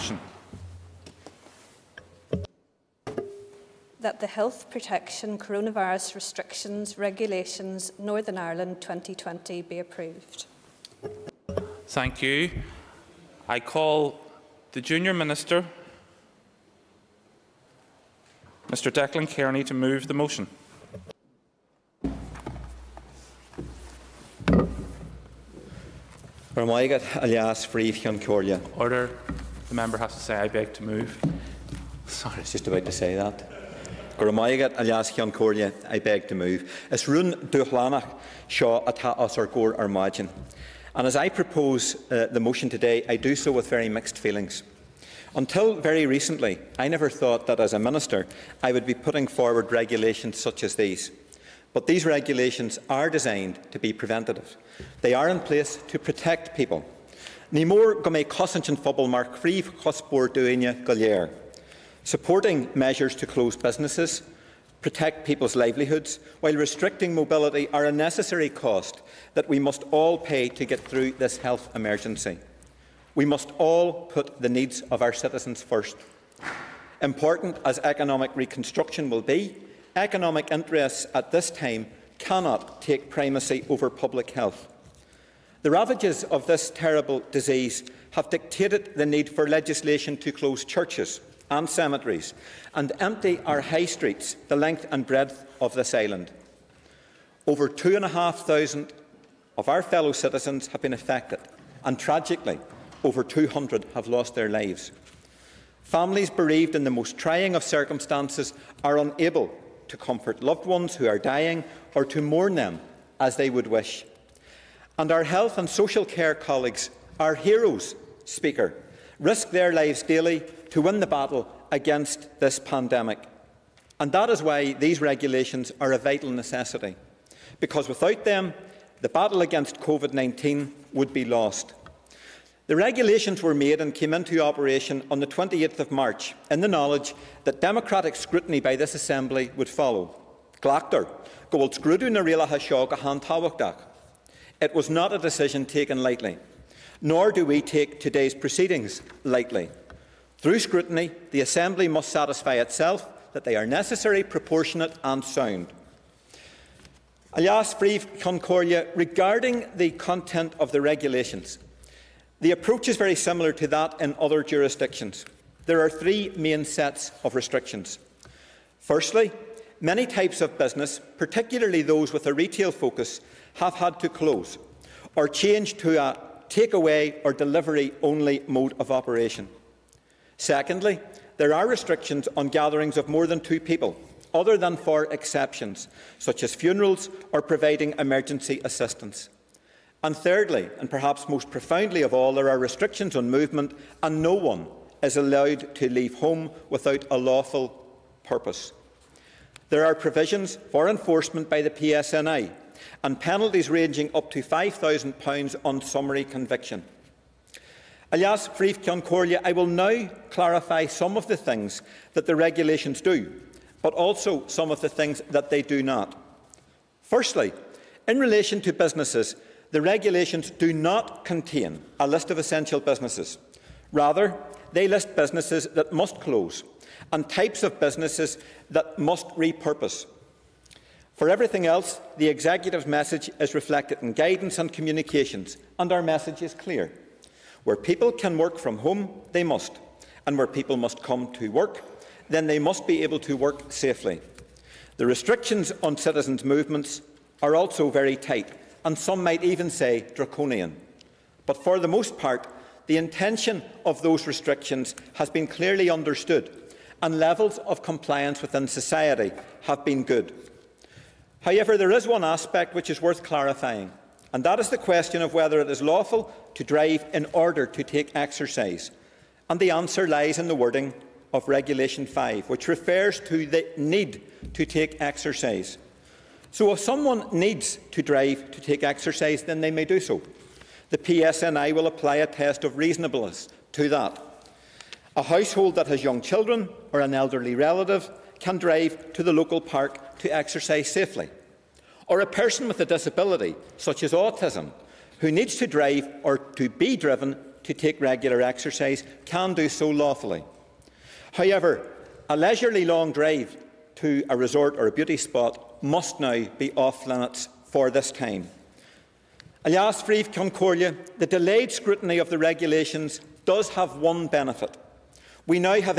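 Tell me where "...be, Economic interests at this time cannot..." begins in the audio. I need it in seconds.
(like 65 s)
79 s.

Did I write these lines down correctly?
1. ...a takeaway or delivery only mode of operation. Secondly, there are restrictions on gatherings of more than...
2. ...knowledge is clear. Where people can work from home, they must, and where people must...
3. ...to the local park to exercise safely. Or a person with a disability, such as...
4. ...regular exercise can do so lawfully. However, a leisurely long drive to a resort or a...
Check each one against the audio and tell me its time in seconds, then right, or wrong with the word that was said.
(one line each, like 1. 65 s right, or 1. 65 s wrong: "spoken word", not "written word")
1. 175 s right
2. 236 s wrong: "message", not "knowledge"
3. 289 s right
4. 297 s right.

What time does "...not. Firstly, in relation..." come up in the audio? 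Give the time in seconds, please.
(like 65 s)
215 s.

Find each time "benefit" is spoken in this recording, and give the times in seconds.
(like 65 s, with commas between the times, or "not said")
314 s.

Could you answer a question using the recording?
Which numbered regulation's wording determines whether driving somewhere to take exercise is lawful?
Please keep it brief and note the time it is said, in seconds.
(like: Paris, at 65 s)
Regulation 5, at 271 s.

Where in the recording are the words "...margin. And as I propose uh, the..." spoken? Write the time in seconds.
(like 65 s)
39 s.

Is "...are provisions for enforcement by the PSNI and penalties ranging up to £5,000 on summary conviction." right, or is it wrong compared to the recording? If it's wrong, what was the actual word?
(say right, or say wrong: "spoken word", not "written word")
right.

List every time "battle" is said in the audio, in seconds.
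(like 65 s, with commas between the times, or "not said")
121 s, 129 s.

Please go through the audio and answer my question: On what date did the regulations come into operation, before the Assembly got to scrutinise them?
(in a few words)
28th of March.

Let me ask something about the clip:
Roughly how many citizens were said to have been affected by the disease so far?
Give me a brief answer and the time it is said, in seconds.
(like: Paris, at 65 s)
Over 2,500, at 97 s.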